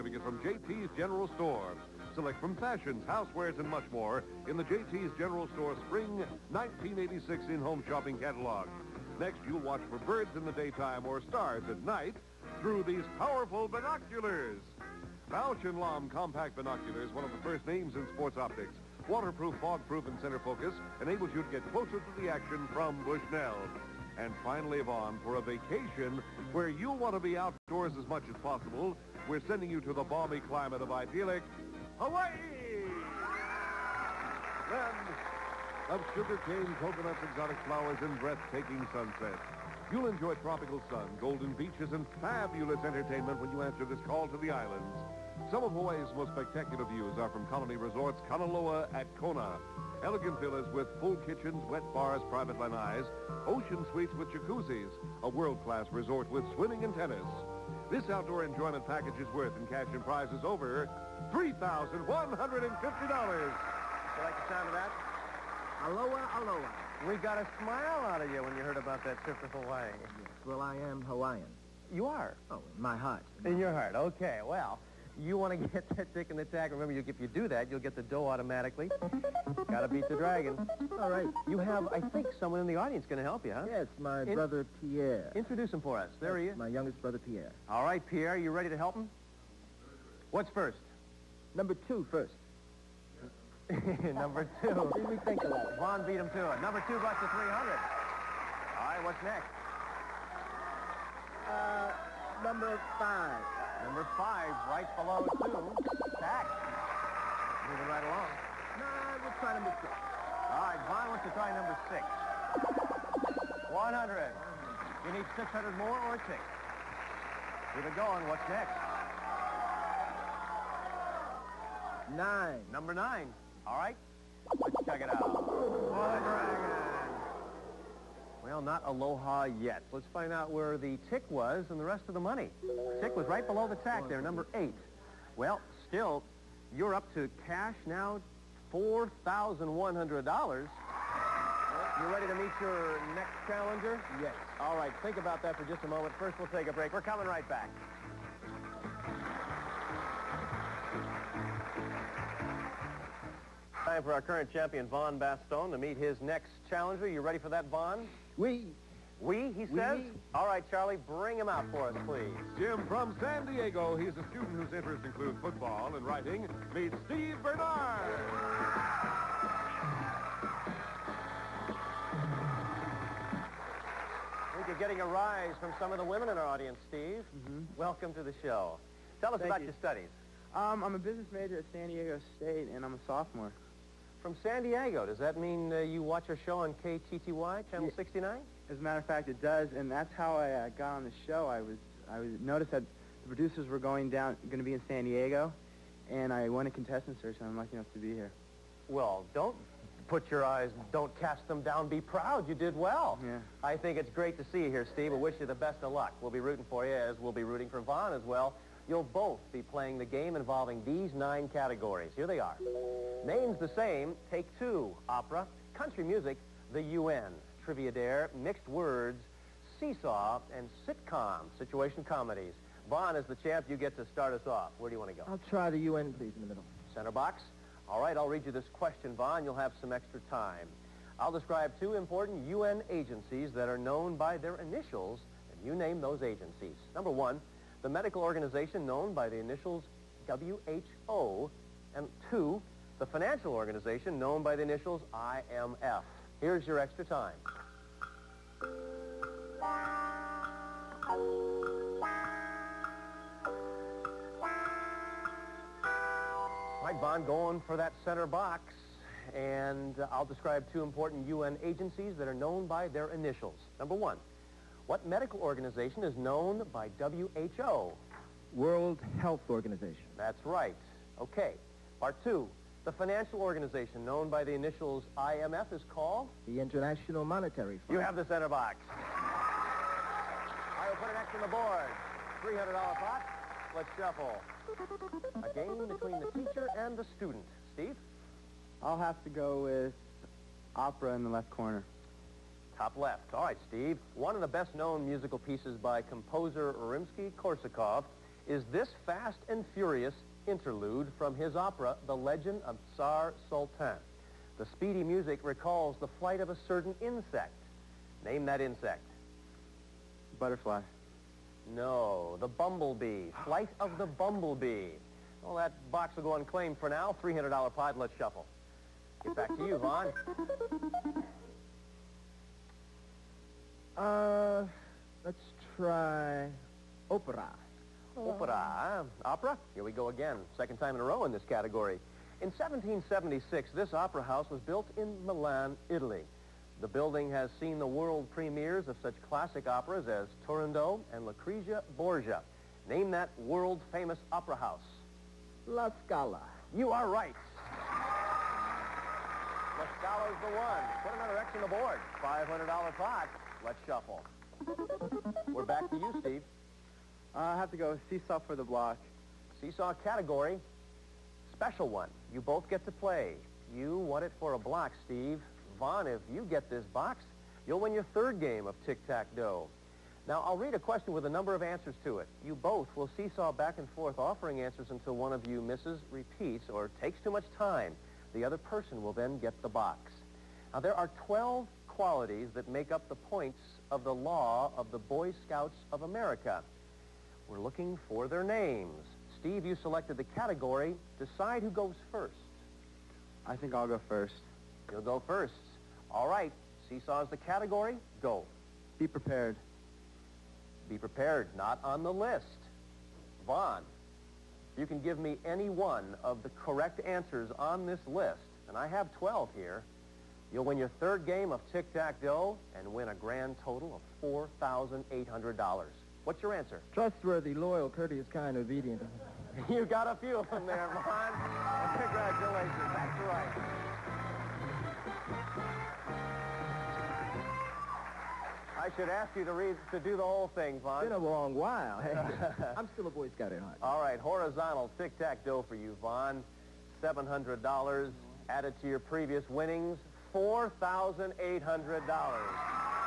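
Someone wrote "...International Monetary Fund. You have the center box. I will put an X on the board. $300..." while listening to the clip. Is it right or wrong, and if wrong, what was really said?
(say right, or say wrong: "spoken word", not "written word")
right.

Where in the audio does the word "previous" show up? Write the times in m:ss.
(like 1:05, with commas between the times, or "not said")
7:19.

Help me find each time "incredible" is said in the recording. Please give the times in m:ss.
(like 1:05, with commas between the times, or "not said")
not said.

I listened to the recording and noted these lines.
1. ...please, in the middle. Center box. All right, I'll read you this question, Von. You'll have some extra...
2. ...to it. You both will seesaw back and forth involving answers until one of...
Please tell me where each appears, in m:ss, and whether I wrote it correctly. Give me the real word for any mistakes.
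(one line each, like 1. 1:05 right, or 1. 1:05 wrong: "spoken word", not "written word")
1. 3:46 right
2. 6:12 wrong: "offering", not "involving".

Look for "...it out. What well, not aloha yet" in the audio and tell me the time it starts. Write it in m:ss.
2:05.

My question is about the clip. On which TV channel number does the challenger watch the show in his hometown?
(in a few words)
69.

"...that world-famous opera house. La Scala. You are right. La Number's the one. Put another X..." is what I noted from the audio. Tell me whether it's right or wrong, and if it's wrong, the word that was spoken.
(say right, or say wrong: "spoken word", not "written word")
wrong: "Scala", not "Number".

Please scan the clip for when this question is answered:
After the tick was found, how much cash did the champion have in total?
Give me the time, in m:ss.
2:18.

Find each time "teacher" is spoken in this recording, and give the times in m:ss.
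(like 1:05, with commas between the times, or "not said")
4:46.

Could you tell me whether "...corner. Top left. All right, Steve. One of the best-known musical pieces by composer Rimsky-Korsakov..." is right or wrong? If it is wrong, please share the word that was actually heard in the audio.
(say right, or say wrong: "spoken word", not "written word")
right.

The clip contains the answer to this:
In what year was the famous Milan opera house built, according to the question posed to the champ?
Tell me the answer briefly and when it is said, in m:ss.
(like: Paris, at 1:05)
1776, at 5:32.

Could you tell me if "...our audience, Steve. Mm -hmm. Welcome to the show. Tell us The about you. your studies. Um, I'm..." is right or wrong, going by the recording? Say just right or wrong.
wrong.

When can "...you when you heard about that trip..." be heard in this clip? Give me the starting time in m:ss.
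1:08.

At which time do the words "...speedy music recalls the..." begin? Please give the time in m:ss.
5:04.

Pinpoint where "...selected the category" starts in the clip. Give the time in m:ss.
6:29.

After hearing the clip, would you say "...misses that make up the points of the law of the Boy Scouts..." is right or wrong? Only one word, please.
wrong.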